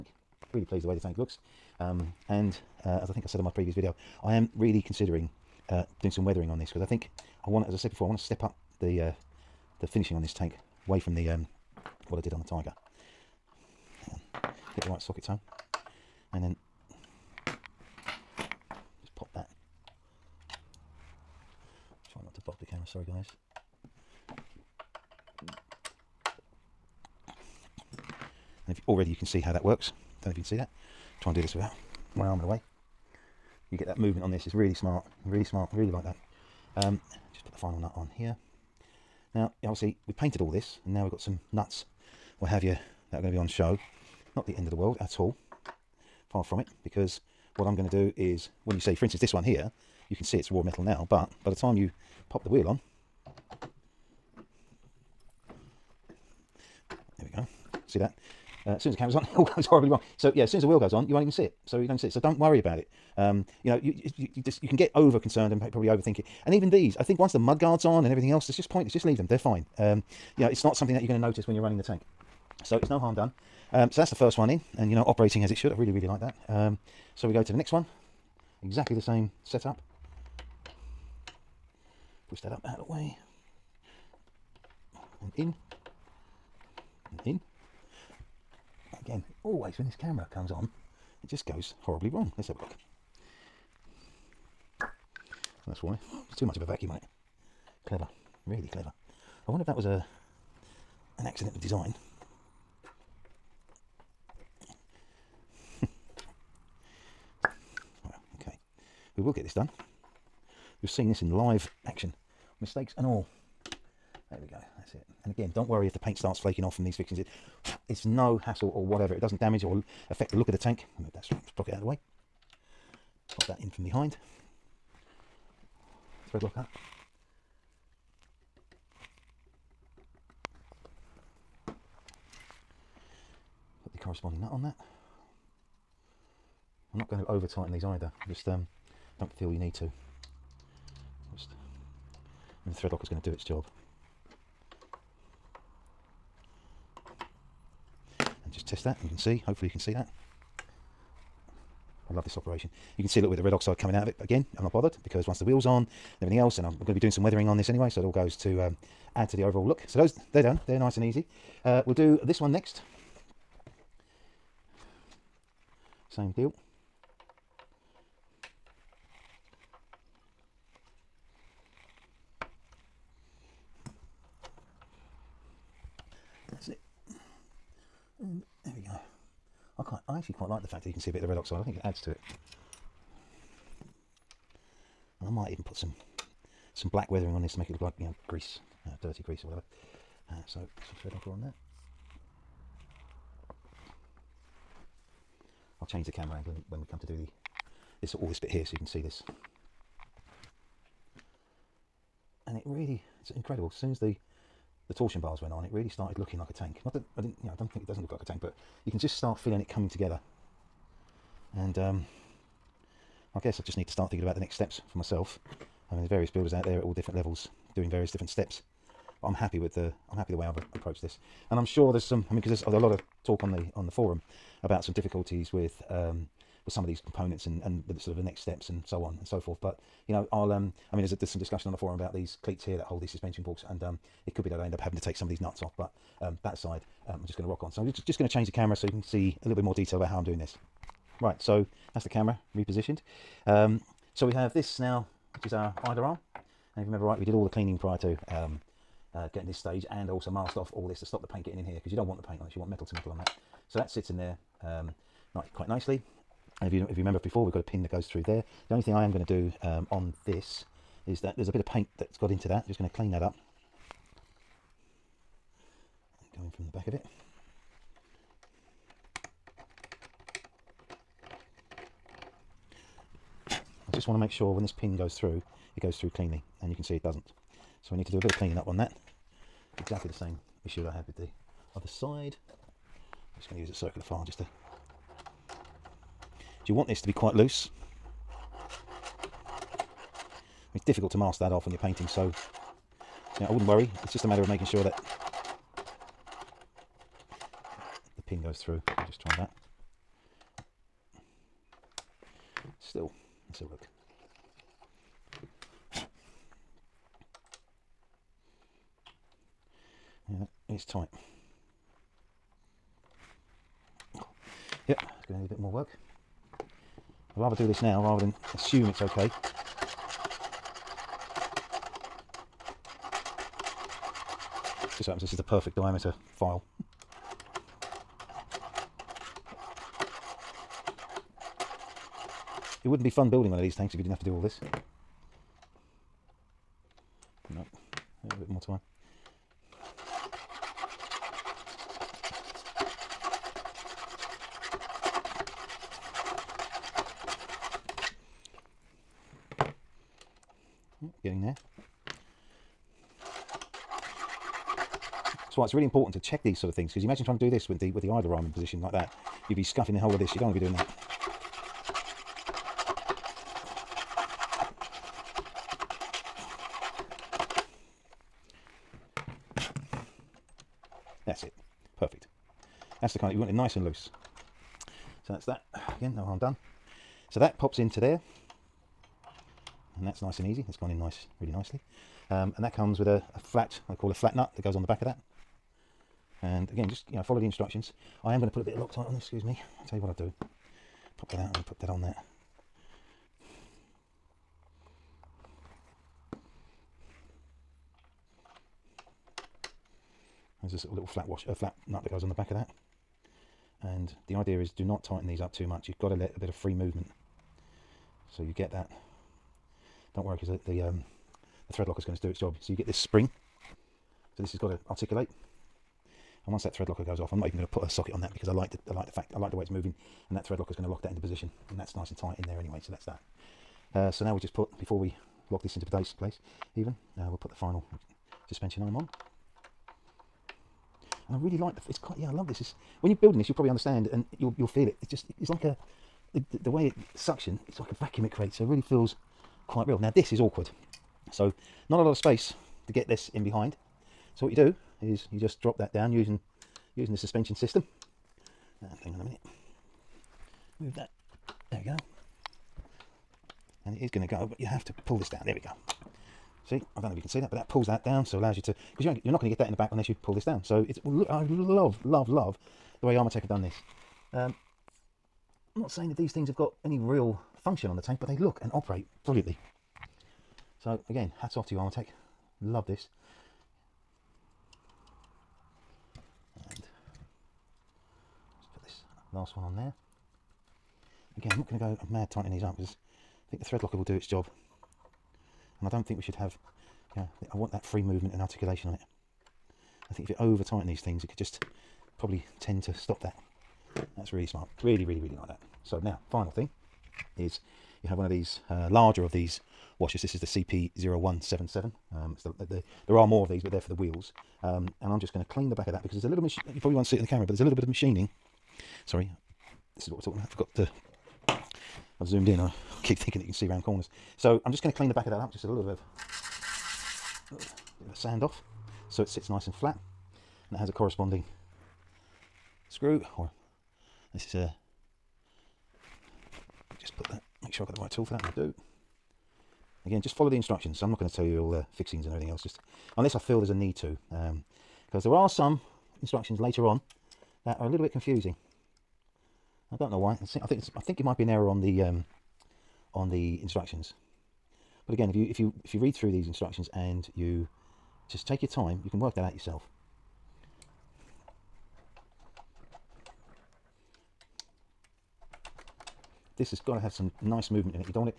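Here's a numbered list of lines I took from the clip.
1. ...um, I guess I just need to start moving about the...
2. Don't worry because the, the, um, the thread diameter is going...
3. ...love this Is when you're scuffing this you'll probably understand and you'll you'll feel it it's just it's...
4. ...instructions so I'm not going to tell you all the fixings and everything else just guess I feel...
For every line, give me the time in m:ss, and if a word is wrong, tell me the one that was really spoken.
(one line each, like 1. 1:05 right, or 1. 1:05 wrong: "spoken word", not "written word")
1. 3:31 wrong: "thinking", not "moving"
2. 6:50 wrong: "locker", not "diameter"
3. 7:12 wrong: "building", not "scuffing"
4. 8:50 wrong: "unless", not "guess".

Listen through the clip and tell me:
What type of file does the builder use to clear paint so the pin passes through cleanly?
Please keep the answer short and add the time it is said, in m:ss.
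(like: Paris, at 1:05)
Circular file, at 4:43.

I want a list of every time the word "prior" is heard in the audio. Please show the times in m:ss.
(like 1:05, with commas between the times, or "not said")
4:07.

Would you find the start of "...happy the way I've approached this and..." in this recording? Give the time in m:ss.
3:40.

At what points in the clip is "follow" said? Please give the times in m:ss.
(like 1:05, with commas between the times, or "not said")
6:27, 8:50.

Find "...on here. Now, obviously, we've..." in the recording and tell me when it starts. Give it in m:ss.
0:37.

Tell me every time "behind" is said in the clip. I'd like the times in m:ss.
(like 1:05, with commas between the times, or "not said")
2:03, 7:23.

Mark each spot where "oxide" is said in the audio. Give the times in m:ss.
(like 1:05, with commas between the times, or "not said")
2:33, 3:01.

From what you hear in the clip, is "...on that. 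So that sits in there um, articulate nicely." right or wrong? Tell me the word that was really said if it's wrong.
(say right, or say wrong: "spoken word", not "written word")
wrong: "quite", not "articulate".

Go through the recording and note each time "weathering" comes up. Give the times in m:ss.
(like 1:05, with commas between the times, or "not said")
0:06, 2:37, 3:07.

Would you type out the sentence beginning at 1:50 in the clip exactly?
You've seen this in live action, mistakes and all.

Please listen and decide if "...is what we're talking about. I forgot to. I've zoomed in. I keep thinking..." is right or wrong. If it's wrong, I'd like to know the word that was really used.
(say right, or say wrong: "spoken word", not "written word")
right.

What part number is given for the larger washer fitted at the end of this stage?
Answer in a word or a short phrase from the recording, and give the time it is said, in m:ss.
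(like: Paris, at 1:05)
CP0177, at 8:20.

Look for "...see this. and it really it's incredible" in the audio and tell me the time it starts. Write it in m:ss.
3:18.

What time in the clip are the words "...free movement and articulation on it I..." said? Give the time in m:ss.
8:07.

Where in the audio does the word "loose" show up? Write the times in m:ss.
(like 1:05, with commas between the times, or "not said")
4:47, 6:13.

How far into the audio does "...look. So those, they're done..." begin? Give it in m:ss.
2:39.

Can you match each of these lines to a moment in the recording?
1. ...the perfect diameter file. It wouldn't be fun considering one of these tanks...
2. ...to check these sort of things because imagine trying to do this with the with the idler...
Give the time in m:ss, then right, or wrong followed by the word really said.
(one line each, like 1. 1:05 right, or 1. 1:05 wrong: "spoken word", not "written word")
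1. 5:25 wrong: "building", not "considering"
2. 5:56 right.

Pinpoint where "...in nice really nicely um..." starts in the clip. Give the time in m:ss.
6:20.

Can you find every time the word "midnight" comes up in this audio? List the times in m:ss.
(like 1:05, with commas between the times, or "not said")
not said.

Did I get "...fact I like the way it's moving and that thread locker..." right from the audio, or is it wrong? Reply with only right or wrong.
right.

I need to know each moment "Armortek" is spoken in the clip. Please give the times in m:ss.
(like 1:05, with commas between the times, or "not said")
7:43, 7:51.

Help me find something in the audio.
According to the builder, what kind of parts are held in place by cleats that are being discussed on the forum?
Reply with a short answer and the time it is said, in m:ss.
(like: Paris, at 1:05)
Suspension balks, at 3:53.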